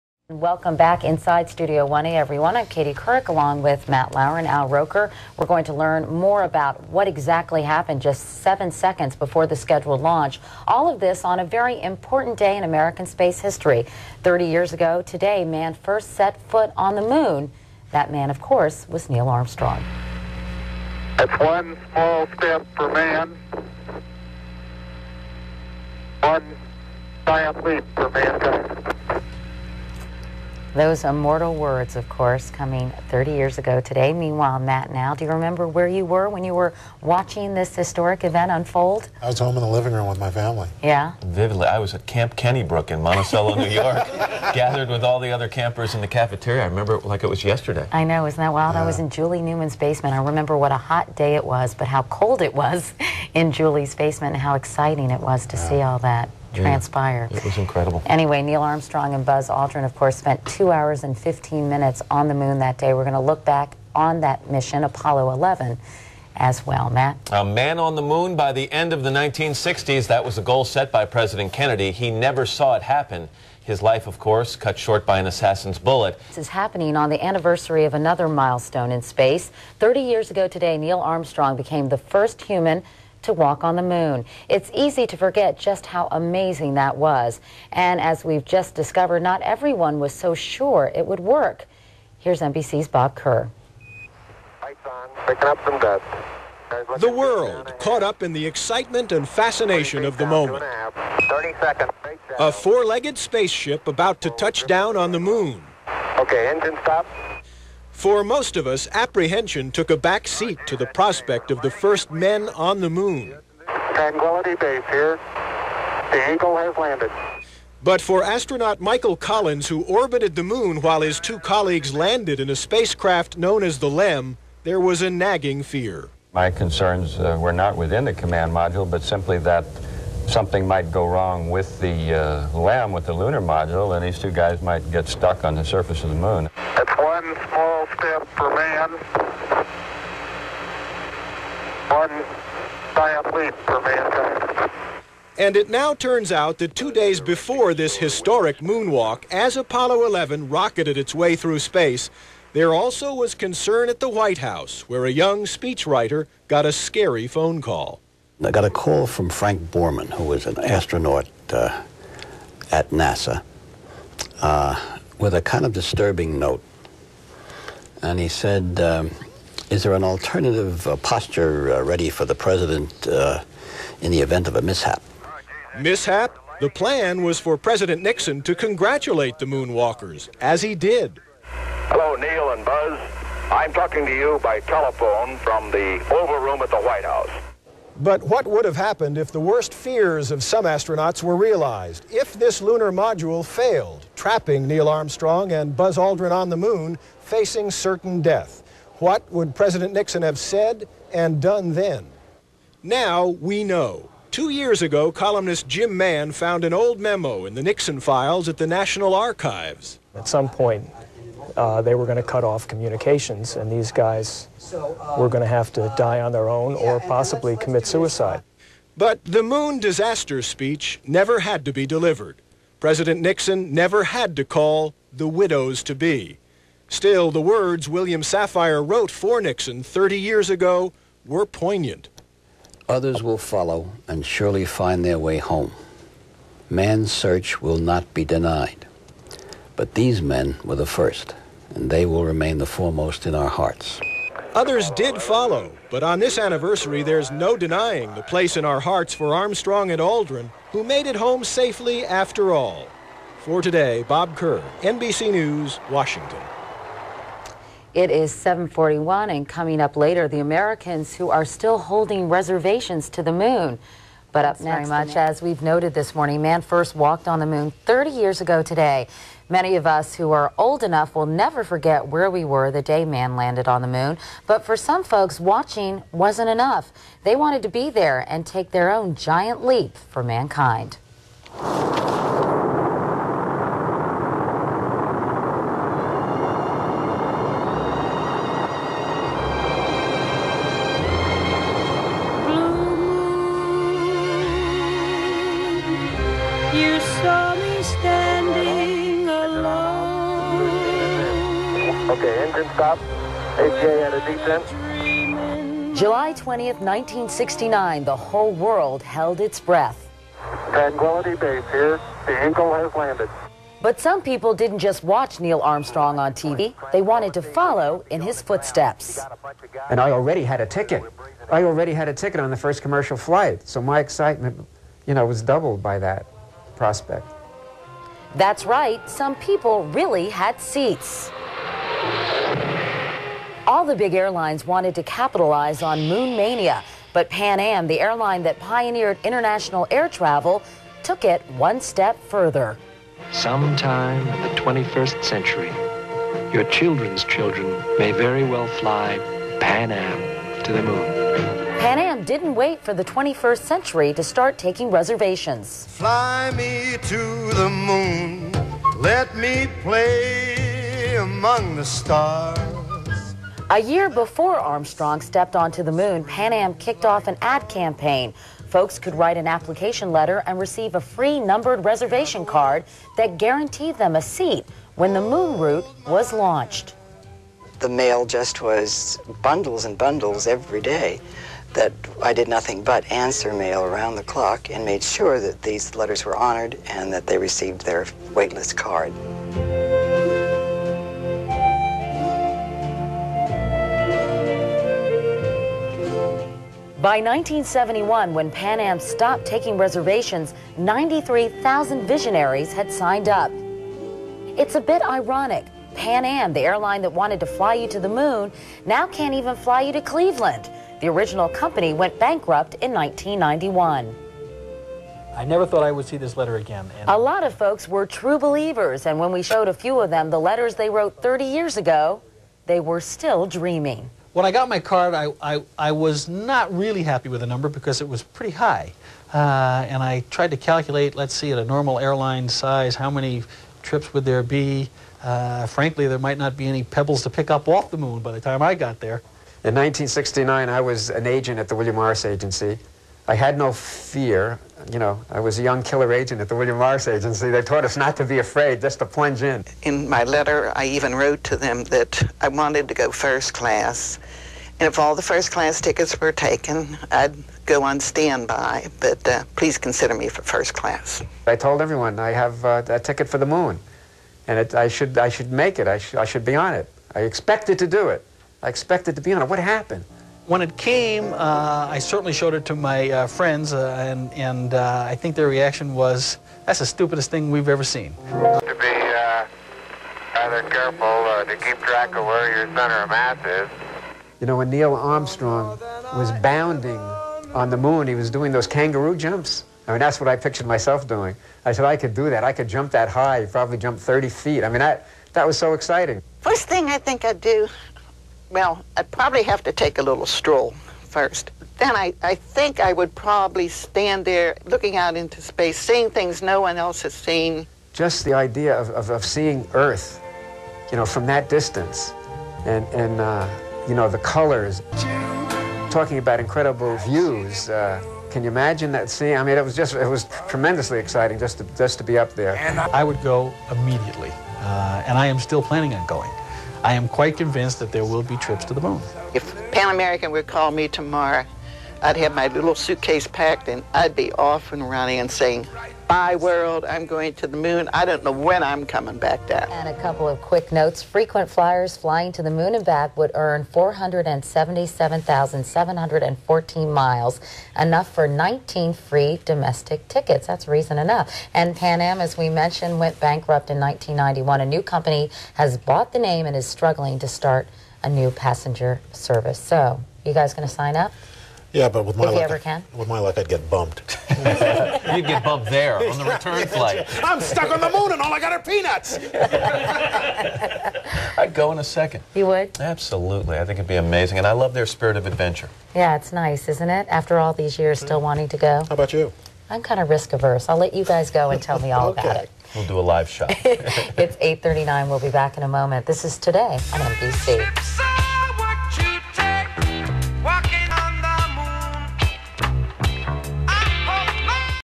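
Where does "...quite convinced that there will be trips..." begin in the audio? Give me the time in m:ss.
8:47.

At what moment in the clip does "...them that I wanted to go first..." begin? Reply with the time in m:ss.
7:31.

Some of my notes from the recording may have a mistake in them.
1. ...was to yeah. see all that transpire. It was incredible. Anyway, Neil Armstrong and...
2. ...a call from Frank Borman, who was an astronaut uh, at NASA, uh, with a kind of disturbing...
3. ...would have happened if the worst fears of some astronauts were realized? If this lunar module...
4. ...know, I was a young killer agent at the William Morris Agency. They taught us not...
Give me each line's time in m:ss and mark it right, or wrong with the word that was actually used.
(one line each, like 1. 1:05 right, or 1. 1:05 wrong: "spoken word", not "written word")
1. 0:55 right
2. 2:38 right
3. 3:08 right
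4. 7:24 right.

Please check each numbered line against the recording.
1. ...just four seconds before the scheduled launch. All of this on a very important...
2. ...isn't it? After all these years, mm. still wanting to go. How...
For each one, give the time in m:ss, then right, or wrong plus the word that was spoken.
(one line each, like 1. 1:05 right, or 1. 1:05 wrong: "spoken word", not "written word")
1. 0:08 wrong: "seven", not "four"
2. 9:36 right.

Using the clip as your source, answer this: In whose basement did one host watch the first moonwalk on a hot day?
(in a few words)
Julie Newman's.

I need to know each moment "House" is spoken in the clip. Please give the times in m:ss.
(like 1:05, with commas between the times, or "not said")
2:34, 3:07.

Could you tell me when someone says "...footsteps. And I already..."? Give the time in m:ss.
5:18.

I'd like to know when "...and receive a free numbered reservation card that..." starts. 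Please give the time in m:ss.
6:10.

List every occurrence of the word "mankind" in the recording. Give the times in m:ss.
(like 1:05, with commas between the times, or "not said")
0:28, 4:40.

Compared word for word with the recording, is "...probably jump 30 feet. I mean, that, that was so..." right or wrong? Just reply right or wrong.
right.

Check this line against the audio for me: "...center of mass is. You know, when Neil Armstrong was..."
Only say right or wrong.
right.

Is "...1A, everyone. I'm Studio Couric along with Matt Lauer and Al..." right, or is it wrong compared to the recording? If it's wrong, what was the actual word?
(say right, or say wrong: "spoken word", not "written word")
wrong: "Katie", not "Studio".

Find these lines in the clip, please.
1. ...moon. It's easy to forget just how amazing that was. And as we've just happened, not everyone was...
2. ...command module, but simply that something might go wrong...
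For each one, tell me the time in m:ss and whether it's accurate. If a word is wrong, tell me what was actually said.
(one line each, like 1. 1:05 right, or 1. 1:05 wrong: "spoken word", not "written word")
1. 1:23 wrong: "discovered", not "happened"
2. 2:08 right.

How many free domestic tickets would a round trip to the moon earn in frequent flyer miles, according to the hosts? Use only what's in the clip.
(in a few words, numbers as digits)
19.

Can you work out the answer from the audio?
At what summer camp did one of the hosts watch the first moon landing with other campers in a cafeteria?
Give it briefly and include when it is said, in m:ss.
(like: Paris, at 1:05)
Camp Kennybrook, at 0:42.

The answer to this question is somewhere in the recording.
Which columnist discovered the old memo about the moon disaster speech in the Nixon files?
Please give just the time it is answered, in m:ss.
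3:25.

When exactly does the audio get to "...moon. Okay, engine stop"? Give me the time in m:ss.
1:45.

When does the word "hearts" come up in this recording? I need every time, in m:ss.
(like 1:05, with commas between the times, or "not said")
4:03, 4:08.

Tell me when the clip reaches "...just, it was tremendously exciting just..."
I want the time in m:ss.
8:39.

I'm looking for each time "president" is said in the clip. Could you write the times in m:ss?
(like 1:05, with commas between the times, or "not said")
1:11, 2:52, 2:57, 3:19, 3:42.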